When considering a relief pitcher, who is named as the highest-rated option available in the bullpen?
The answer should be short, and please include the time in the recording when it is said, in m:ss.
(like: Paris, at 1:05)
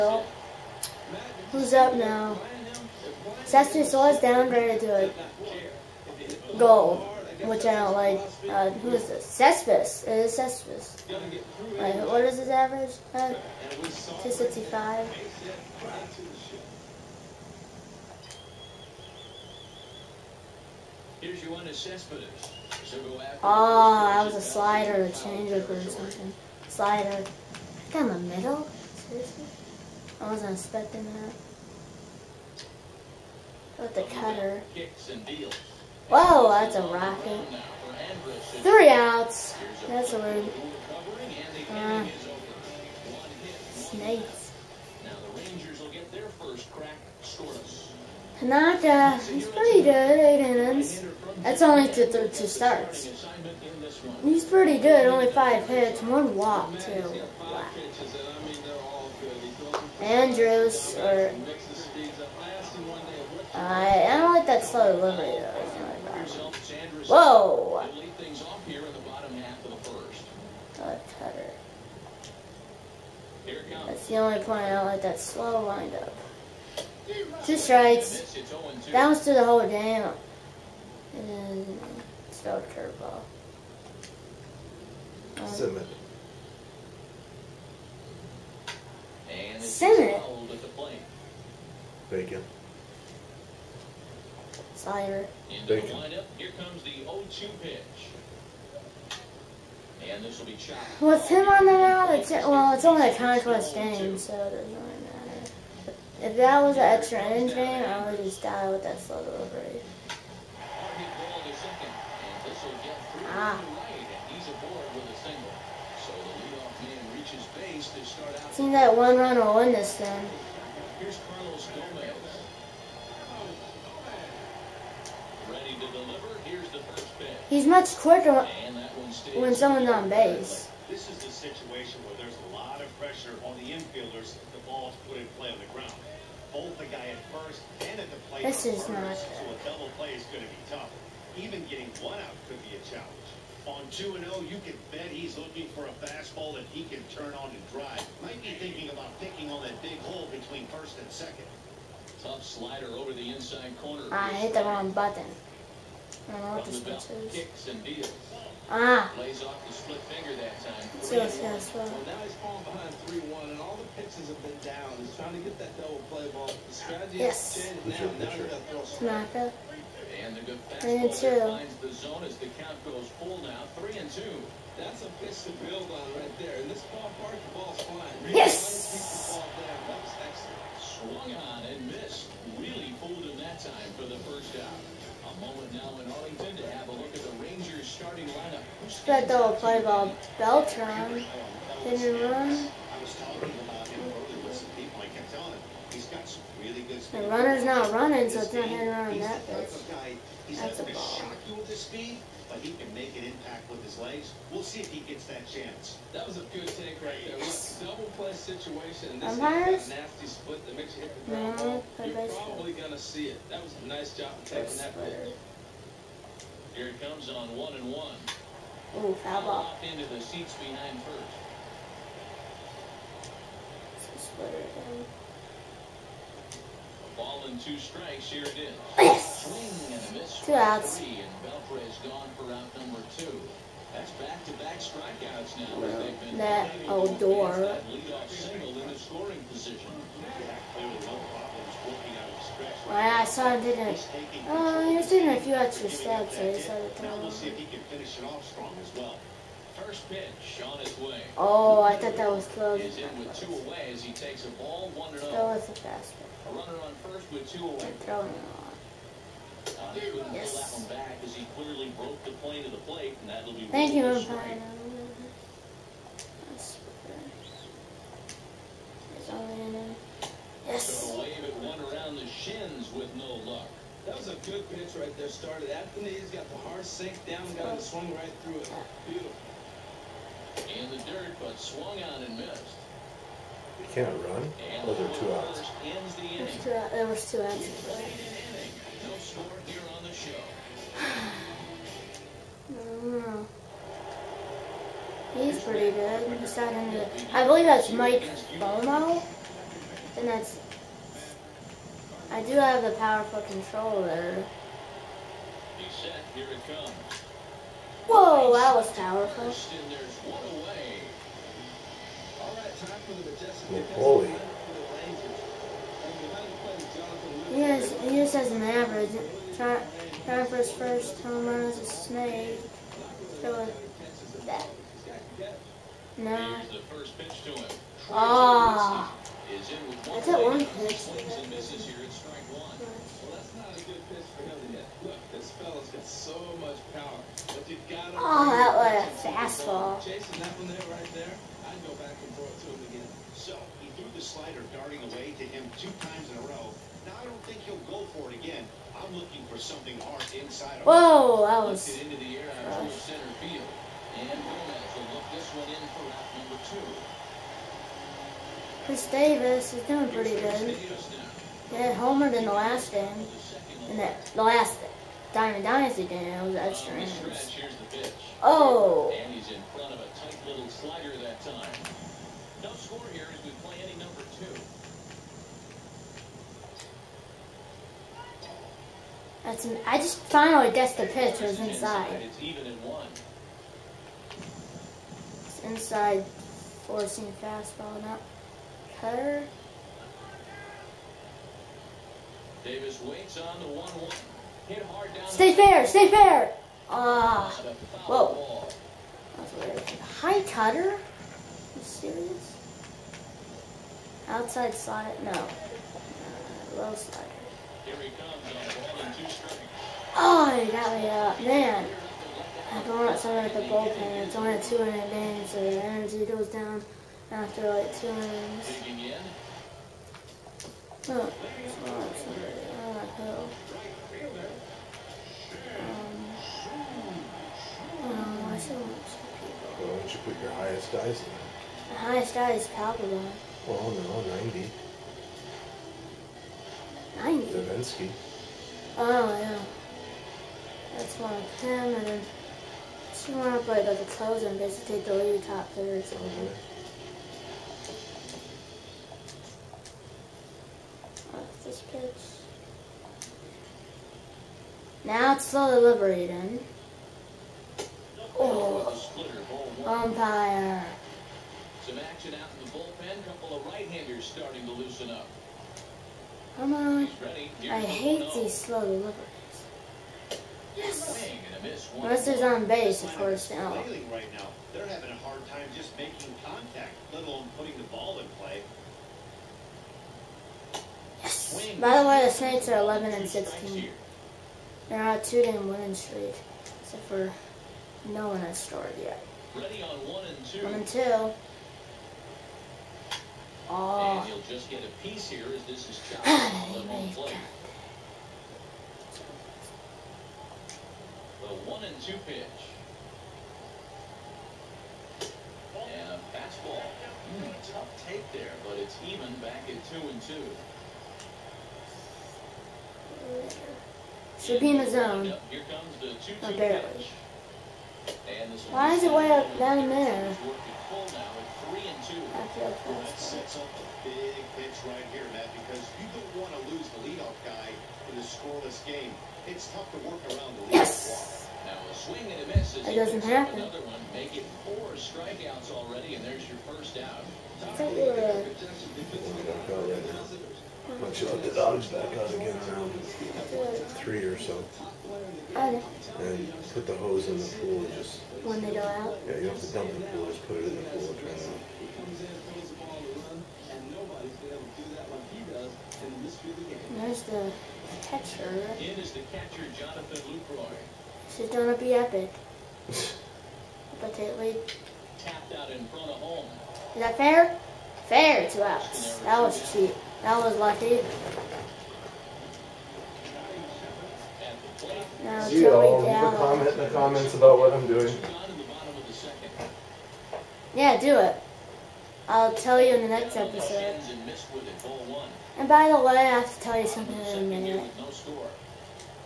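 Papelbon, at 7:12.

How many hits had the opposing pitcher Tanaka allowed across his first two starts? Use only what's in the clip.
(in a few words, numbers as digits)
5.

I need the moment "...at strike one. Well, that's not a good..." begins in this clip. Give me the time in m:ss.
5:31.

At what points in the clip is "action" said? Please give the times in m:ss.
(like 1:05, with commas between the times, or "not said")
7:41.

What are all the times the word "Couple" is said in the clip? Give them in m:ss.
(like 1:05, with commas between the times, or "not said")
7:43.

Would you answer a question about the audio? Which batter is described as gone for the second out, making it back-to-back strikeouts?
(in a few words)
Beltre.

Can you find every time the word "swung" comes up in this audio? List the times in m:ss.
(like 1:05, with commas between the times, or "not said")
3:00, 4:41.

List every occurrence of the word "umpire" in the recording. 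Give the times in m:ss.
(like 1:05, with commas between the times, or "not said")
4:24, 7:39.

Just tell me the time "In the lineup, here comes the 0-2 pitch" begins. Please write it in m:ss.
1:35.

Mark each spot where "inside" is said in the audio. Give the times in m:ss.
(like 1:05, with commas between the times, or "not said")
2:33, 5:50, 6:21, 6:25.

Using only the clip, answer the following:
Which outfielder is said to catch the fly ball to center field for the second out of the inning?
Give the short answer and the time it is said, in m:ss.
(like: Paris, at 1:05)
Gomez, at 5:54.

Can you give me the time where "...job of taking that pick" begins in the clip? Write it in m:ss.
3:34.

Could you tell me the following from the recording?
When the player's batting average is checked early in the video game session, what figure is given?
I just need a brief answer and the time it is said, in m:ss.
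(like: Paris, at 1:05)
265, at 0:13.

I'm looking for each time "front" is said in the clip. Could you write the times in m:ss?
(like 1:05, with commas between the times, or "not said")
6:09, 9:25.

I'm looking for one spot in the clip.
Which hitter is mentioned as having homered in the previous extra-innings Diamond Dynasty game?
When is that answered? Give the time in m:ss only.
5:58.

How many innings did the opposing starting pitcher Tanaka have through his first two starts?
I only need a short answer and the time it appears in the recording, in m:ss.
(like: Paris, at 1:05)
8, at 0:50.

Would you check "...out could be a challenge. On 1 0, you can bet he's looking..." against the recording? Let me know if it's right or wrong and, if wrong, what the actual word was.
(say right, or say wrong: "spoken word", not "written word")
wrong: "2", not "1".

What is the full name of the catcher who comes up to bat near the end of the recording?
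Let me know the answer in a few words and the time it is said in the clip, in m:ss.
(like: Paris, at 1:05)
Jonathan Lucroy, at 9:19.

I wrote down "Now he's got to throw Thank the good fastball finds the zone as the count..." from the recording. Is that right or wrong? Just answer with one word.
wrong.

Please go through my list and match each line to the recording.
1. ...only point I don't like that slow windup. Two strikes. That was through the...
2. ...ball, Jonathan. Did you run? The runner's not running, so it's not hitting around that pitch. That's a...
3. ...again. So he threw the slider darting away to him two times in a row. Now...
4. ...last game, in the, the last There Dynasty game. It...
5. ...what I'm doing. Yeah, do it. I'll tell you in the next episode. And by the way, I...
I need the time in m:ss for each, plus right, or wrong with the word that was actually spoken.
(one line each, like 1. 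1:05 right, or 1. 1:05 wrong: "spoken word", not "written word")
1. 1:14 right
2. 3:09 wrong: "Beltran", not "Jonathan"
3. 5:42 right
4. 6:02 wrong: "Diamond", not "There"
5. 9:37 right.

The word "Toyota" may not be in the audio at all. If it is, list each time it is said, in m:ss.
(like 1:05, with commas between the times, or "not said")
not said.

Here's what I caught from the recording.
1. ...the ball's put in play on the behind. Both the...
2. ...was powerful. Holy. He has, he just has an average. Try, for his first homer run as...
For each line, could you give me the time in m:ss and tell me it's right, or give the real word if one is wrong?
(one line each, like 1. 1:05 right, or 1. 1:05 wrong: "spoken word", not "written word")
1. 2:14 wrong: "ground", not "behind"
2. 5:08 right.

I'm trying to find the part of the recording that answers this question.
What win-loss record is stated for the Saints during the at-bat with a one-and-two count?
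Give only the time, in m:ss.
8:02.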